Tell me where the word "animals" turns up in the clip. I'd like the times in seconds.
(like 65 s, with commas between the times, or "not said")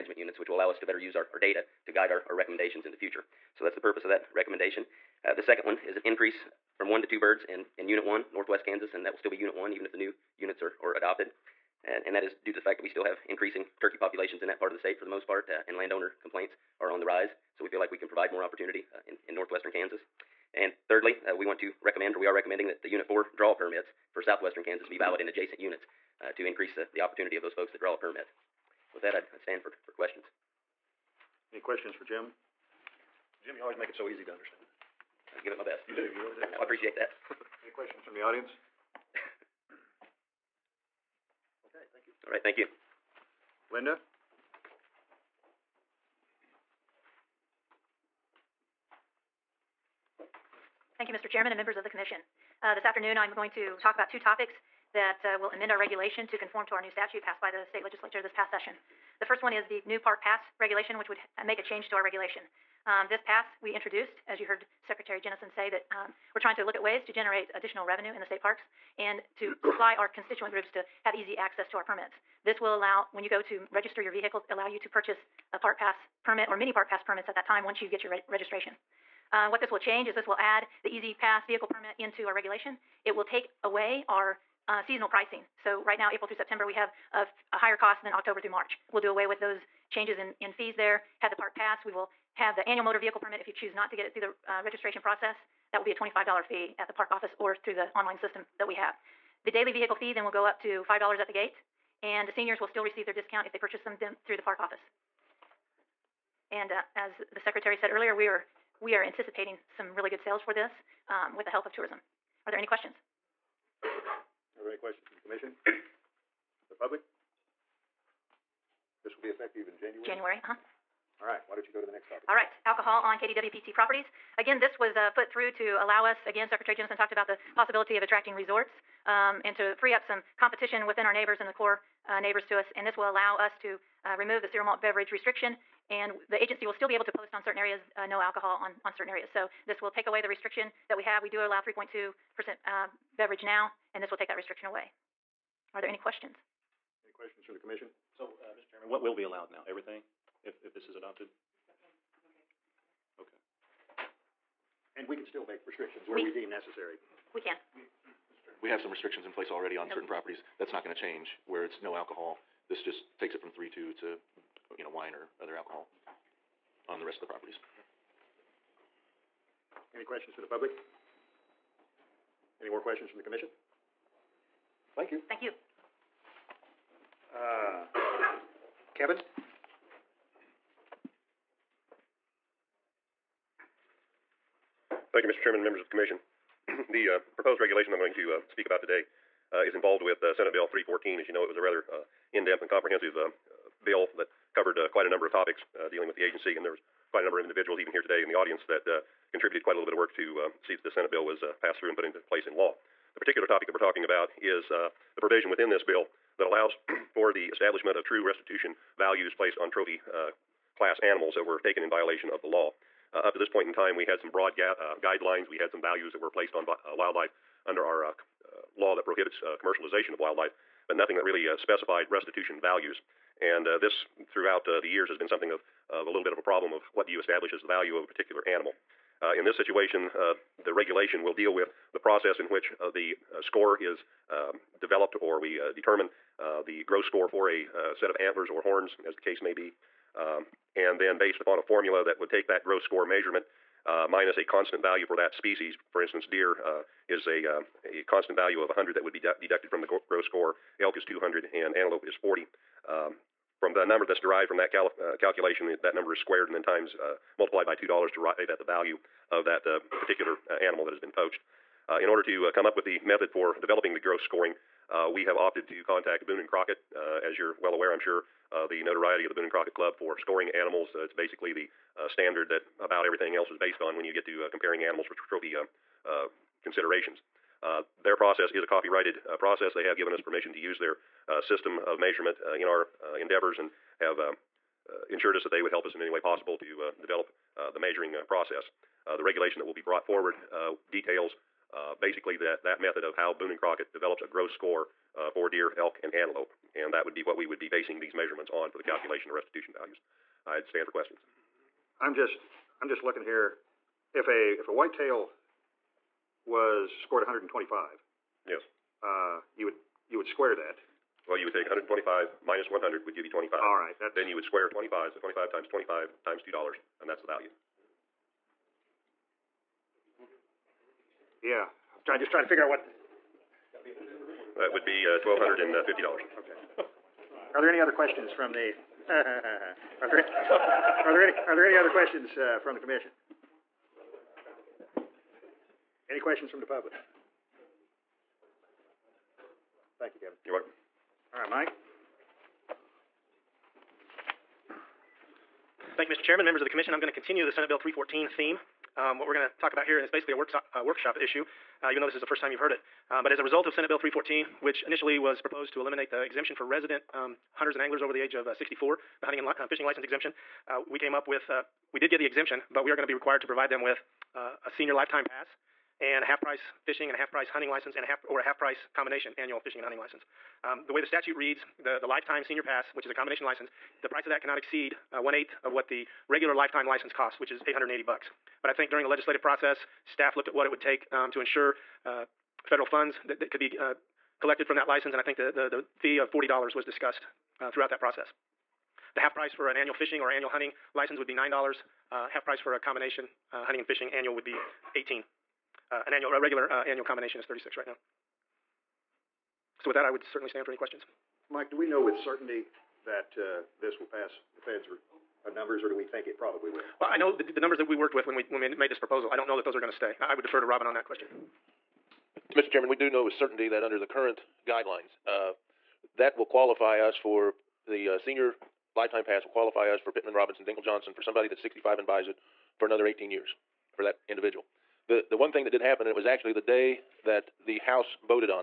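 210 s, 228 s, 260 s, 270 s, 274 s.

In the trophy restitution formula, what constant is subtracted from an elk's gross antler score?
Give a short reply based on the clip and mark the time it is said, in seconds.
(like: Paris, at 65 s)
200, at 251 s.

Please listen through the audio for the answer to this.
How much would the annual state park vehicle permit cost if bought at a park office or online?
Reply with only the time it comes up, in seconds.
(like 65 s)
95 s.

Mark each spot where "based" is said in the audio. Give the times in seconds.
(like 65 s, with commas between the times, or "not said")
241 s, 273 s.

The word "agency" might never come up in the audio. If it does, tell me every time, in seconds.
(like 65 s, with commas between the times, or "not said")
136 s, 196 s.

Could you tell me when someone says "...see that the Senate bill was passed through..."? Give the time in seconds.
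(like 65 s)
200 s.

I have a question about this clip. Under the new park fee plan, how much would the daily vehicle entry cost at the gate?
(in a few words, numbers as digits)
$5.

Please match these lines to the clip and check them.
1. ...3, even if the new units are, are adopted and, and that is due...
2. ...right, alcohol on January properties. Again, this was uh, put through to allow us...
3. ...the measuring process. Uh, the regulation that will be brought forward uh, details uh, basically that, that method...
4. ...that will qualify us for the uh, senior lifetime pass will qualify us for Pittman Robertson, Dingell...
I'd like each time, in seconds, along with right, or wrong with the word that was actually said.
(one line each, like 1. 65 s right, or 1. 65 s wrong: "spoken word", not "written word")
1. 9 s wrong: "1", not "3"
2. 122 s wrong: "KDWPT", not "January"
3. 287 s right
4. 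416 s right.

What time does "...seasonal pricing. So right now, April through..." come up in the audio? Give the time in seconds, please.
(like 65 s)
84 s.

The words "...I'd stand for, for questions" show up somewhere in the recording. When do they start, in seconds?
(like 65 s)
29 s.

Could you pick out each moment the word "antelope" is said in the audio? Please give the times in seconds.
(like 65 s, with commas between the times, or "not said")
251 s, 296 s.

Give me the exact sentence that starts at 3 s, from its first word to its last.
So that's the purpose of that recommendation.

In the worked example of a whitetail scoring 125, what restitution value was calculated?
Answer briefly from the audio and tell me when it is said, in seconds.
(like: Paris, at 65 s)
$1,250, at 325 s.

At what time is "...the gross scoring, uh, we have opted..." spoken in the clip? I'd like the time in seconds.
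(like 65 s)
263 s.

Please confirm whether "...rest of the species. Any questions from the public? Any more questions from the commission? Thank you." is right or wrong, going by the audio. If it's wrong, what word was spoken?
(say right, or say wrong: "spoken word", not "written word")
wrong: "properties", not "species".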